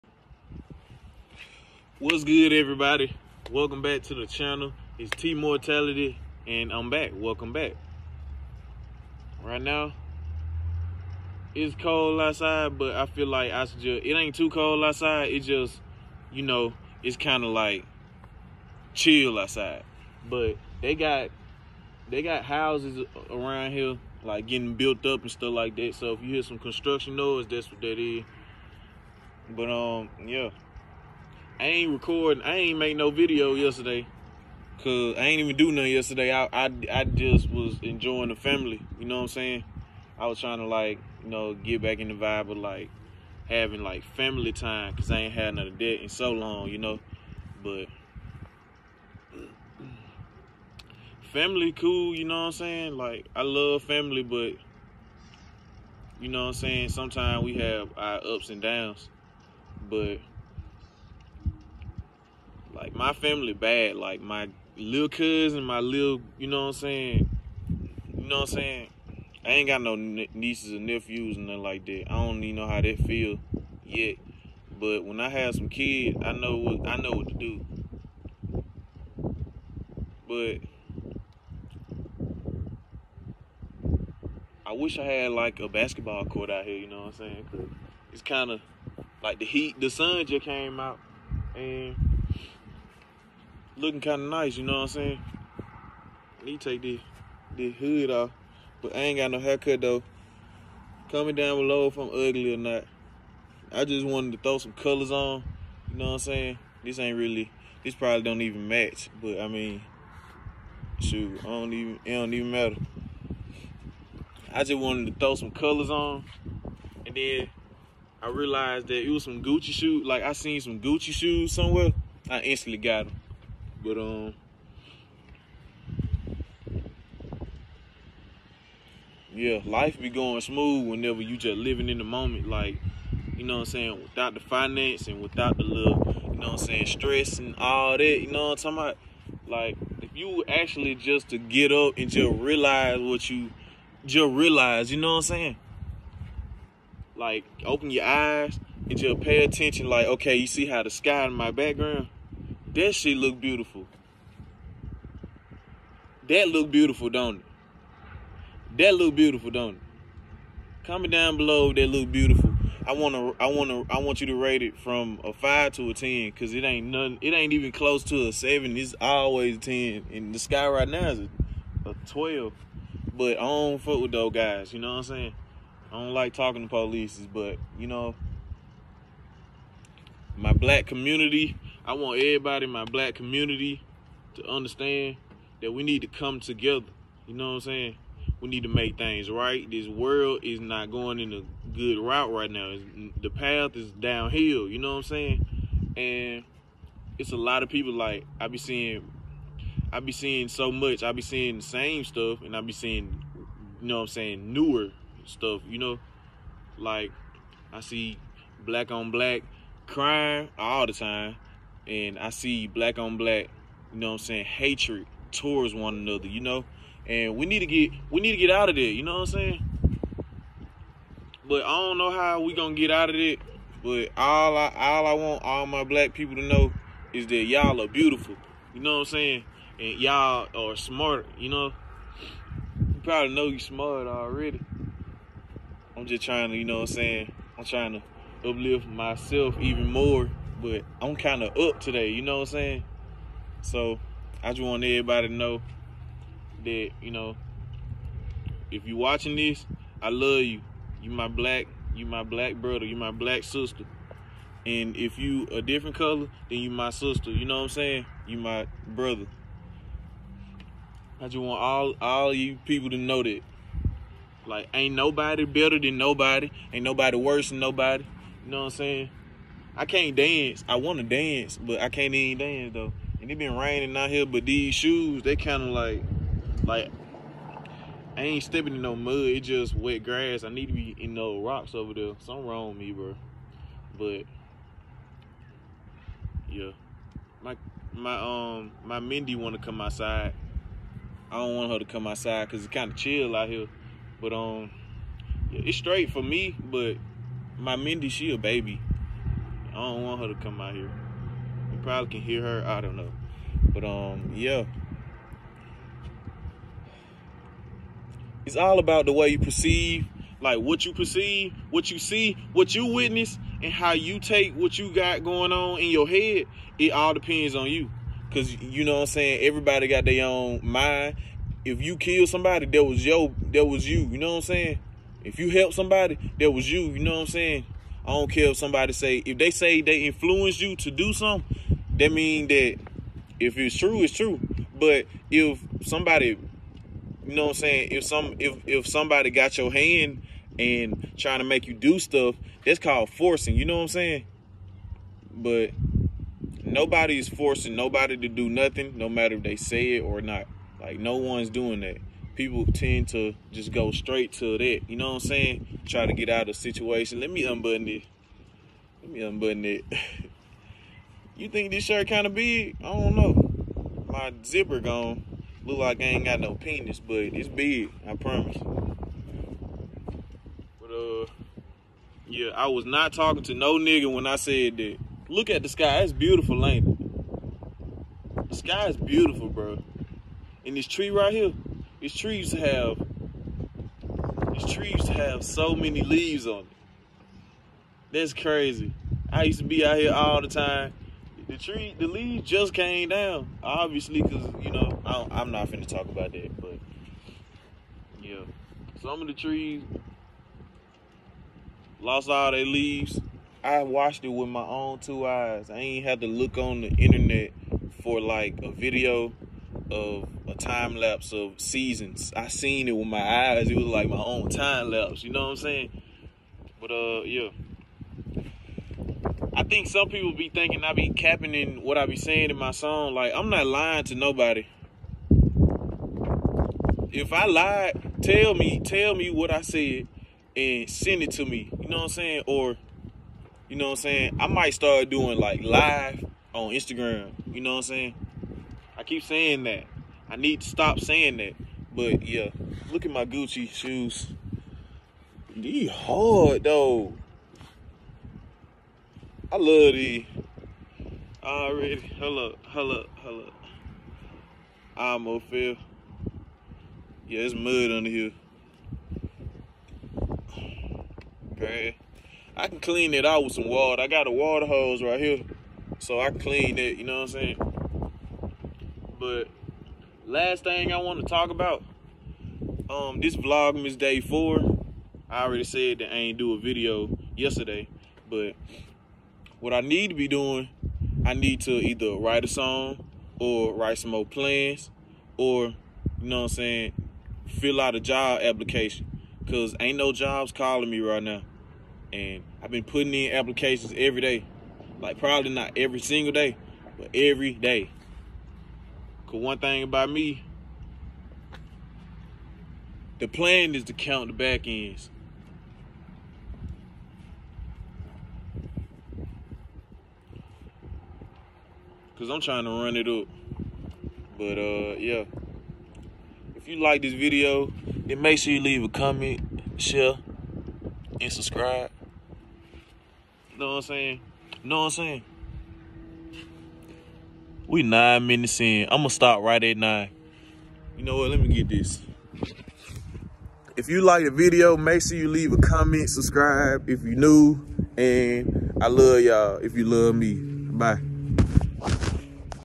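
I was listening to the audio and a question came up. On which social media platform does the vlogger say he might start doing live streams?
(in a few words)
Instagram.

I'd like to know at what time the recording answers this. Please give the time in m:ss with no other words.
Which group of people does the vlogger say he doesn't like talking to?
2:56.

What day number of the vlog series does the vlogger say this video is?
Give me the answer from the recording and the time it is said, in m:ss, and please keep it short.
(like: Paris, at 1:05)
4, at 7:53.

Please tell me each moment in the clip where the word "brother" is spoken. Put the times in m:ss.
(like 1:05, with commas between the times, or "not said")
4:12, 4:18.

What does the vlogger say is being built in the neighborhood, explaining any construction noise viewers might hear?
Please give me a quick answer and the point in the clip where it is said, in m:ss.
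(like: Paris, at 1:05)
Houses, at 0:22.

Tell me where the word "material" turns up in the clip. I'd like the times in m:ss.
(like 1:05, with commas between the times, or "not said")
not said.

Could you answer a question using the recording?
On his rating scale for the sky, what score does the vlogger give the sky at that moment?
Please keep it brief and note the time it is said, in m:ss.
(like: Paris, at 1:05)
12, at 2:51.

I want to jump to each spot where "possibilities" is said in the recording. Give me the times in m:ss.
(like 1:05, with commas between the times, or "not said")
not said.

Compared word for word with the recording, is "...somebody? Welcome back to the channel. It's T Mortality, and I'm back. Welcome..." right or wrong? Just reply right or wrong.
wrong.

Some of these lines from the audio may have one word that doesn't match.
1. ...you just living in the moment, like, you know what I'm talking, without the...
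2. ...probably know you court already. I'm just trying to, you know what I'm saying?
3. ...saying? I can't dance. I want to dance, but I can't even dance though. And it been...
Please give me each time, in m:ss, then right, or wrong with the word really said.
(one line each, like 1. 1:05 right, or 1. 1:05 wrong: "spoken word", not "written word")
1. 2:11 wrong: "saying", not "talking"
2. 3:53 wrong: "smart", not "court"
3. 4:28 right.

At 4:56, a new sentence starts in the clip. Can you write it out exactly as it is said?
But my Mindy, she a baby.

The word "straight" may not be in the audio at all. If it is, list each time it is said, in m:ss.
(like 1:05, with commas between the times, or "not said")
4:55, 5:53.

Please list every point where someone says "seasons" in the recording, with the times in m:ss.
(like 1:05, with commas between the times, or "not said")
6:51.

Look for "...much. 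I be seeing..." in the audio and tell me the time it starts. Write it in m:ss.
3:20.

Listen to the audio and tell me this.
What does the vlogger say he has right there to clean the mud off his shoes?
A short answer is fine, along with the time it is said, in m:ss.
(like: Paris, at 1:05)
Water hose, at 7:44.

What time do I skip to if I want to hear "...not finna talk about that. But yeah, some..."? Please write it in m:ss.
6:35.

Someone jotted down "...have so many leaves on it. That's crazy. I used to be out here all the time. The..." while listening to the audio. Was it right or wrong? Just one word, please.
right.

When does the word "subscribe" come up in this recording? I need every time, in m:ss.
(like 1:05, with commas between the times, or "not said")
8:41, 8:56.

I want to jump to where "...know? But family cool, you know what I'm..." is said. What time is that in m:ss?
0:46.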